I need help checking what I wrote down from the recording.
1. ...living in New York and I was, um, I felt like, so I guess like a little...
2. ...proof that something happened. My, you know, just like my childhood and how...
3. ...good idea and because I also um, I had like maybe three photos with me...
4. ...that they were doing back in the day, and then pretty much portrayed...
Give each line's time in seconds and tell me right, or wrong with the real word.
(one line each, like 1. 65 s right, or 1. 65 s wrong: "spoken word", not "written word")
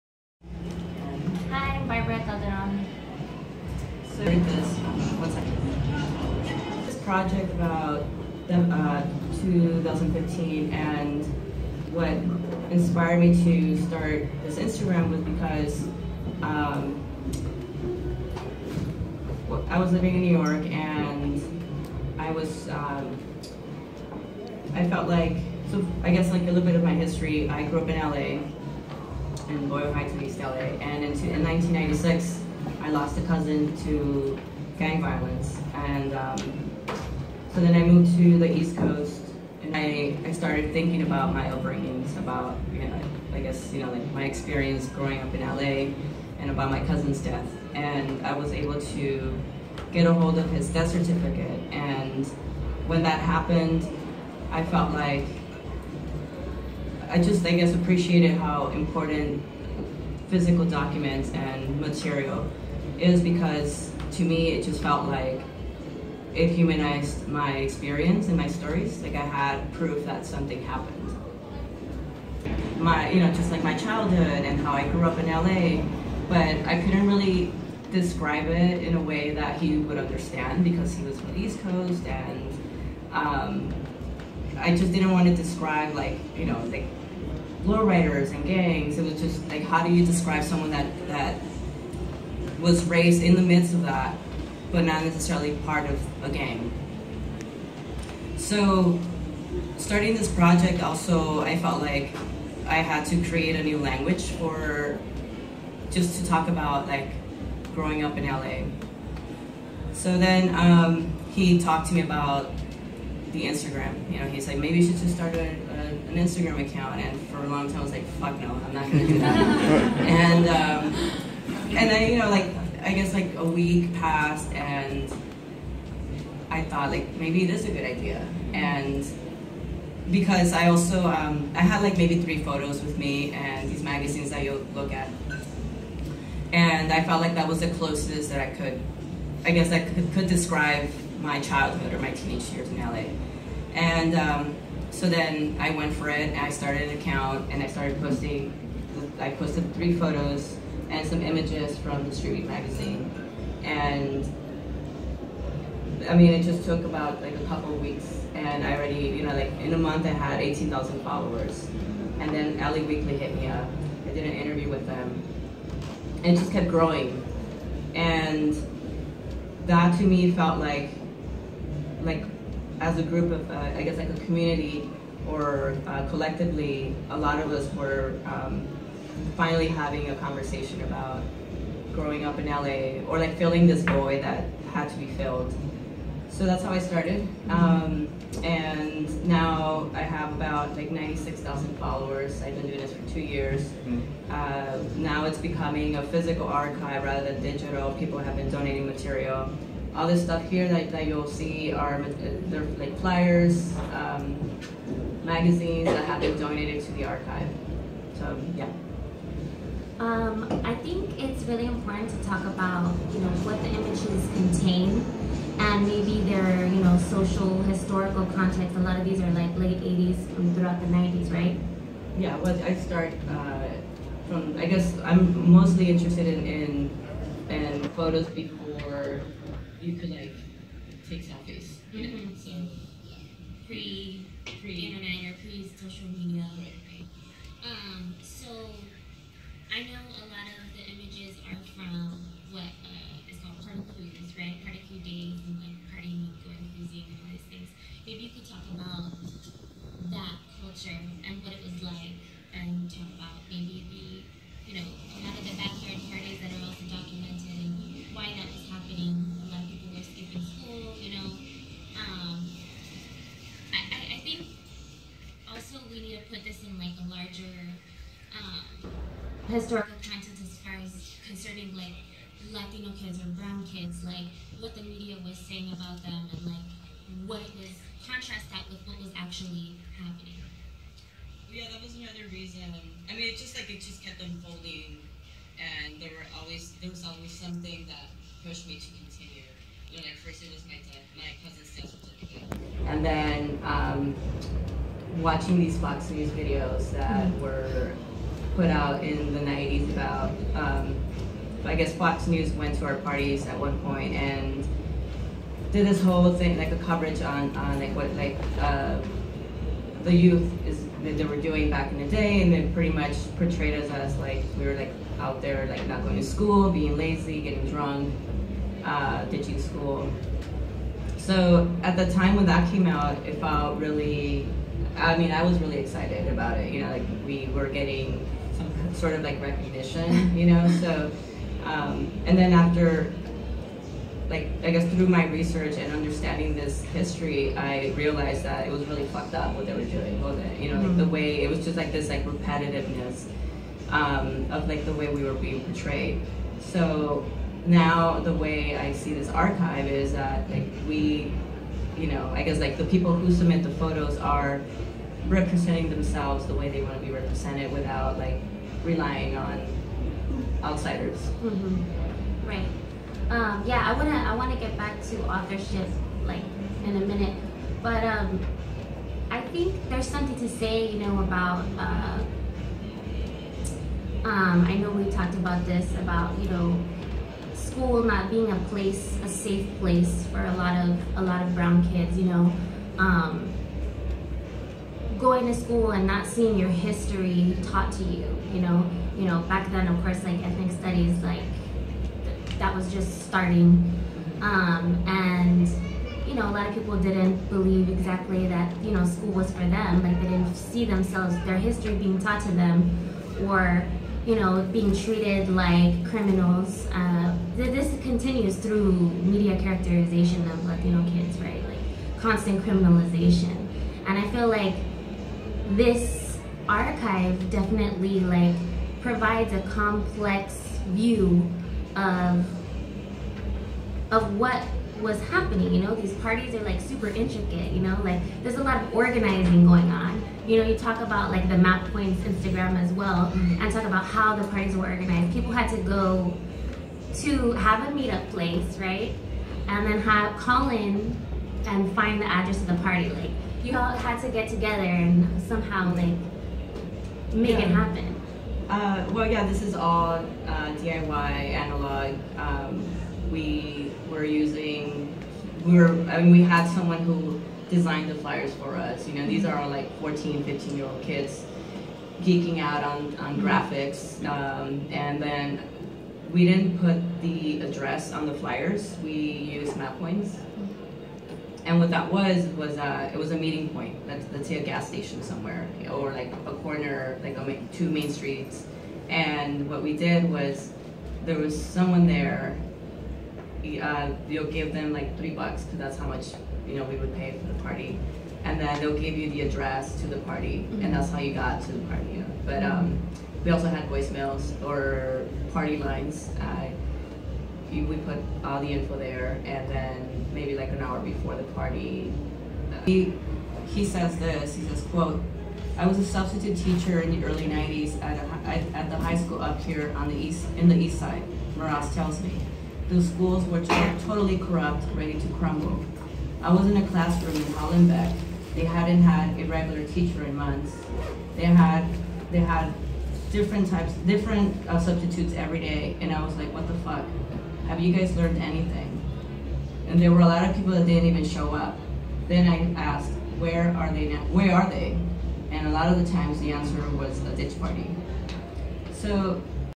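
1. 19 s right
2. 69 s right
3. 127 s right
4. 311 s right.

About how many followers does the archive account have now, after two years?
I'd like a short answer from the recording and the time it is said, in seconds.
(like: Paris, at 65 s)
96,000, at 190 s.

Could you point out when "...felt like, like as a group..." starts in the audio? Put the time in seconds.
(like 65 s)
170 s.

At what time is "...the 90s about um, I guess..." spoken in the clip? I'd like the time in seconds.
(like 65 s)
299 s.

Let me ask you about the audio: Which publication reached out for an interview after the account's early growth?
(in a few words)
LA Weekly.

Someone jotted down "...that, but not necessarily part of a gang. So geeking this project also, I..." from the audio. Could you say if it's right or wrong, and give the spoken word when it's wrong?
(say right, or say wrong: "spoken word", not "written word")
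wrong: "starting", not "geeking".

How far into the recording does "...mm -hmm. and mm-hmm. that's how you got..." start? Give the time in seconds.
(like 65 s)
490 s.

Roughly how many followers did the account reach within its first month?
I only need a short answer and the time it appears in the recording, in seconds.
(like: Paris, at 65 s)
18,000, at 160 s.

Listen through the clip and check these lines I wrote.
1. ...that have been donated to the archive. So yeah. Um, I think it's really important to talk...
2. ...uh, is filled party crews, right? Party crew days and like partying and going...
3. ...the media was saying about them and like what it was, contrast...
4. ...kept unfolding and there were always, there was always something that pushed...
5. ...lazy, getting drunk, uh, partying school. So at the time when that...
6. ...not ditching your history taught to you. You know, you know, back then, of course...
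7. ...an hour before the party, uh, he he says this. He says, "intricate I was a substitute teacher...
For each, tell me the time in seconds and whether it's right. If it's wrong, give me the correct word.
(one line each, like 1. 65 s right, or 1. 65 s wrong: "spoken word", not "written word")
1. 205 s right
2. 242 s wrong: "called", not "filled"
3. 274 s right
4. 284 s right
5. 316 s wrong: "ditching", not "partying"
6. 386 s wrong: "seeing", not "ditching"
7. 500 s wrong: "quote", not "intricate".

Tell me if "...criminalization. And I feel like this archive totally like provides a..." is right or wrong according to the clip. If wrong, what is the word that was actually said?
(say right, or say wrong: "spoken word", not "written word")
wrong: "definitely", not "totally".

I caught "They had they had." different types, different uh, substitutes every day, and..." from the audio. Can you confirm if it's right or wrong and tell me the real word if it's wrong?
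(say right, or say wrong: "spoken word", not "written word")
right.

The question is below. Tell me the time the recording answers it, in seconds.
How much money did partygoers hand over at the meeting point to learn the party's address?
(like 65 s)
485 s.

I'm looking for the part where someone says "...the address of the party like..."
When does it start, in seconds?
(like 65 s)
442 s.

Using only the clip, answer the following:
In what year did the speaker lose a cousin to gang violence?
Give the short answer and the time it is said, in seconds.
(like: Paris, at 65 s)
1996, at 31 s.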